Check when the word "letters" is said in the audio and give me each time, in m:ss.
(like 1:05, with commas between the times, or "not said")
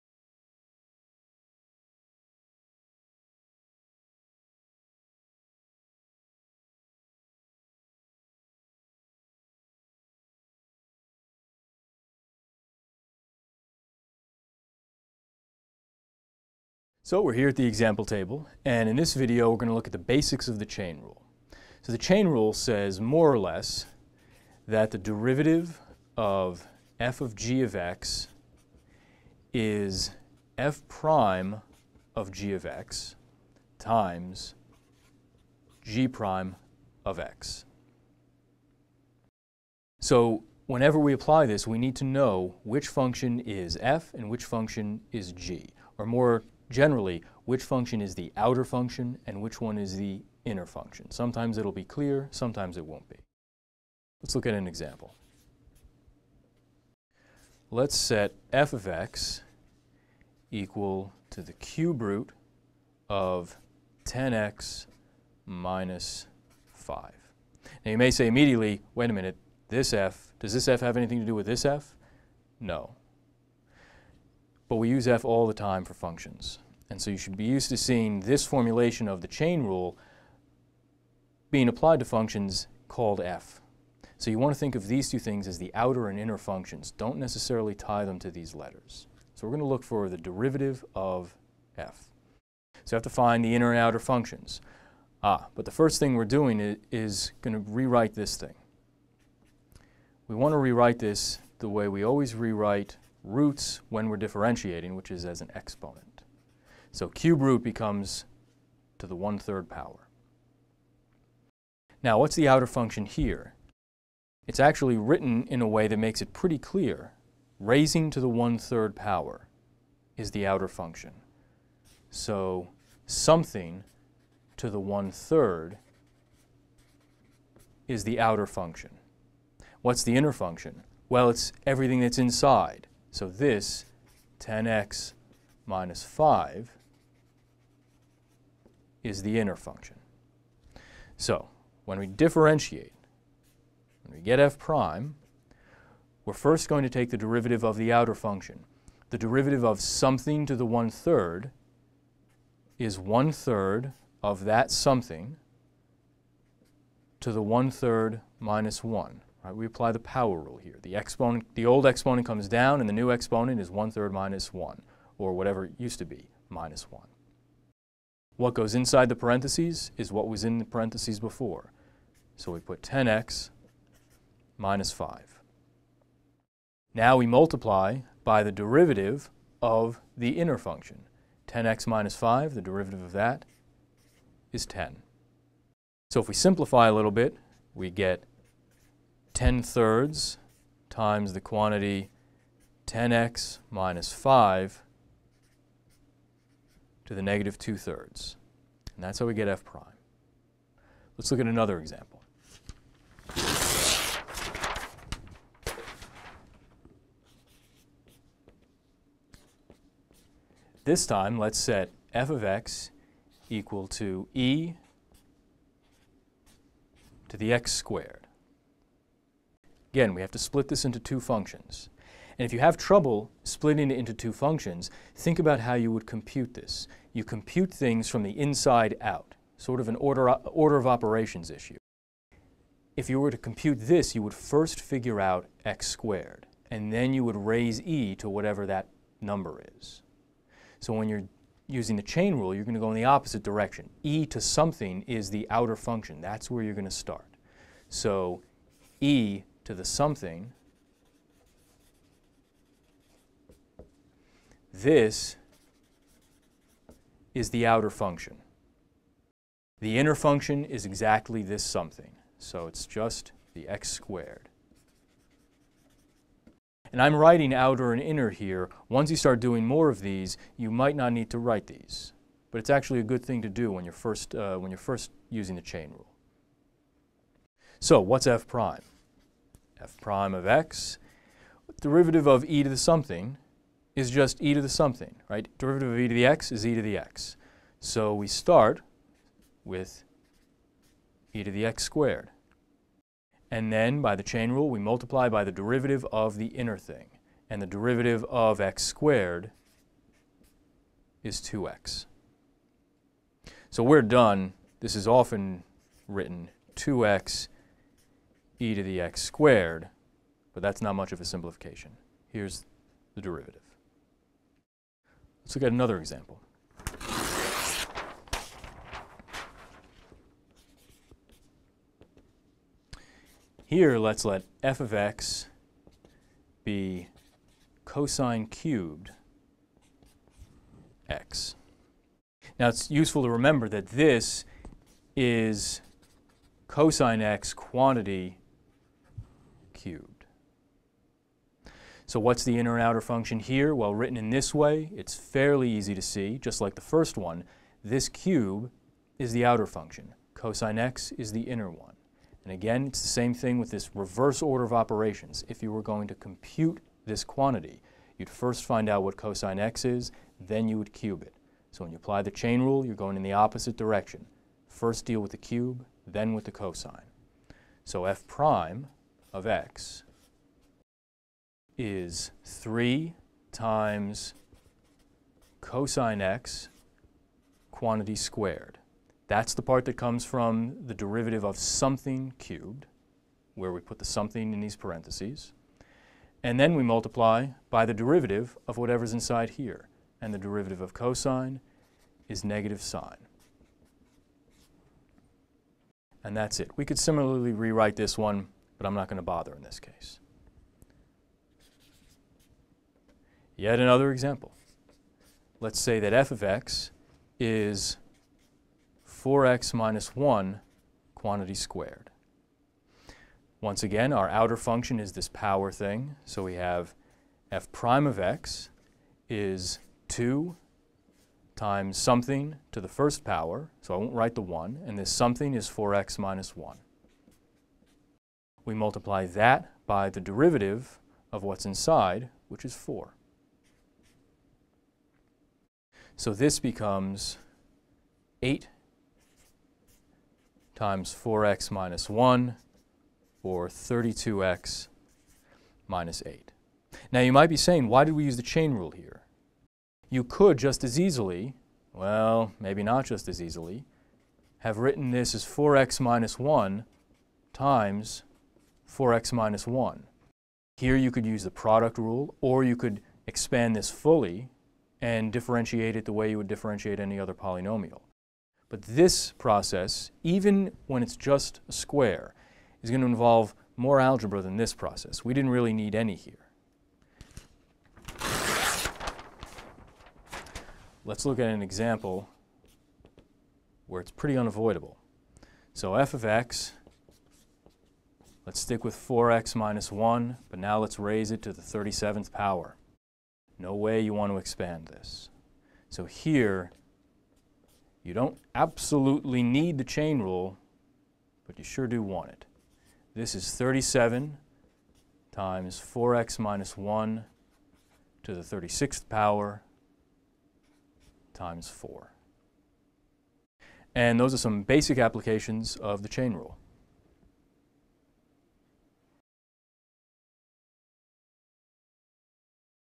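1:28.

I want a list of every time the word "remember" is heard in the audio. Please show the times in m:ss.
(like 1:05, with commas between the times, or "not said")
5:33.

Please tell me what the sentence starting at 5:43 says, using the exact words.
Well, written in this way, it's fairly easy to see, just like the first one.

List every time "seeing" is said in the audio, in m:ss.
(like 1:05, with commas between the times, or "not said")
1:17.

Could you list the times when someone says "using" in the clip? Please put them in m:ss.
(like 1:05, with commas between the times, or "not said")
4:01, 4:35.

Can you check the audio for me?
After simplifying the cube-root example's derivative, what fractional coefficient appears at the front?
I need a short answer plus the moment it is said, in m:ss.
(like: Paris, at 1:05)
10/3, at 3:09.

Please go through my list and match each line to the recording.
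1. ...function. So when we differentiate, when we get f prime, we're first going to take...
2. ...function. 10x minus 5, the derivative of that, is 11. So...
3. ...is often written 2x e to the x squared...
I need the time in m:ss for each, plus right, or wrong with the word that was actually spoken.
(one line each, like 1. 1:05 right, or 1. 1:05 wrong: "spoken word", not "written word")
1. 2:19 right
2. 3:00 wrong: "10", not "11"
3. 5:04 right.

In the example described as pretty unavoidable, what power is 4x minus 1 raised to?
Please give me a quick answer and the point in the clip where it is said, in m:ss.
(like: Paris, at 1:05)
37, at 8:11.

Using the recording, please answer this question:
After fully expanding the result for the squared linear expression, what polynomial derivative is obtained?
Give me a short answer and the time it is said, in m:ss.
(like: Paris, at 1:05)
32x minus 8, at 7:23.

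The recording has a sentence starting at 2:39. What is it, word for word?
Right, we apply the power rule here.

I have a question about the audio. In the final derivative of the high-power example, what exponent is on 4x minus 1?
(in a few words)
36.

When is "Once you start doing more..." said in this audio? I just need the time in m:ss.
4:28.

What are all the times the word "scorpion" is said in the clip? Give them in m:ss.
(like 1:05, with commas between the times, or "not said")
not said.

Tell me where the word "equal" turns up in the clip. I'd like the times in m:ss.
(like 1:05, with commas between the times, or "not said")
1:00, 3:33.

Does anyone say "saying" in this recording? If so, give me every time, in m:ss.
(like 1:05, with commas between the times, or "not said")
7:27.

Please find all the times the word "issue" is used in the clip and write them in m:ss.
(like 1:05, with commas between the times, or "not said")
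3:51.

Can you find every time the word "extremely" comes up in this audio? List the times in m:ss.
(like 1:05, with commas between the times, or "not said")
not said.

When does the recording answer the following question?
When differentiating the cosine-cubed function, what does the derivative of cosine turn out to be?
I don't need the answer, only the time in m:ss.
6:32.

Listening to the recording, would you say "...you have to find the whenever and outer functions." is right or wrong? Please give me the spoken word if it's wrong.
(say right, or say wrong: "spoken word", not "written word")
wrong: "inner", not "whenever".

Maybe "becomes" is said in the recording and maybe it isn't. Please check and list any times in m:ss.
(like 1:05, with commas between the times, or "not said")
1:47, 7:16.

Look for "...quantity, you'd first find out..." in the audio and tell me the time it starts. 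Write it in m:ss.
5:57.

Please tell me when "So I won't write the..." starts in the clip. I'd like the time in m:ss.
7:03.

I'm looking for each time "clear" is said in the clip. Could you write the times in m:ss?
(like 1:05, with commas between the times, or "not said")
0:51, 1:56.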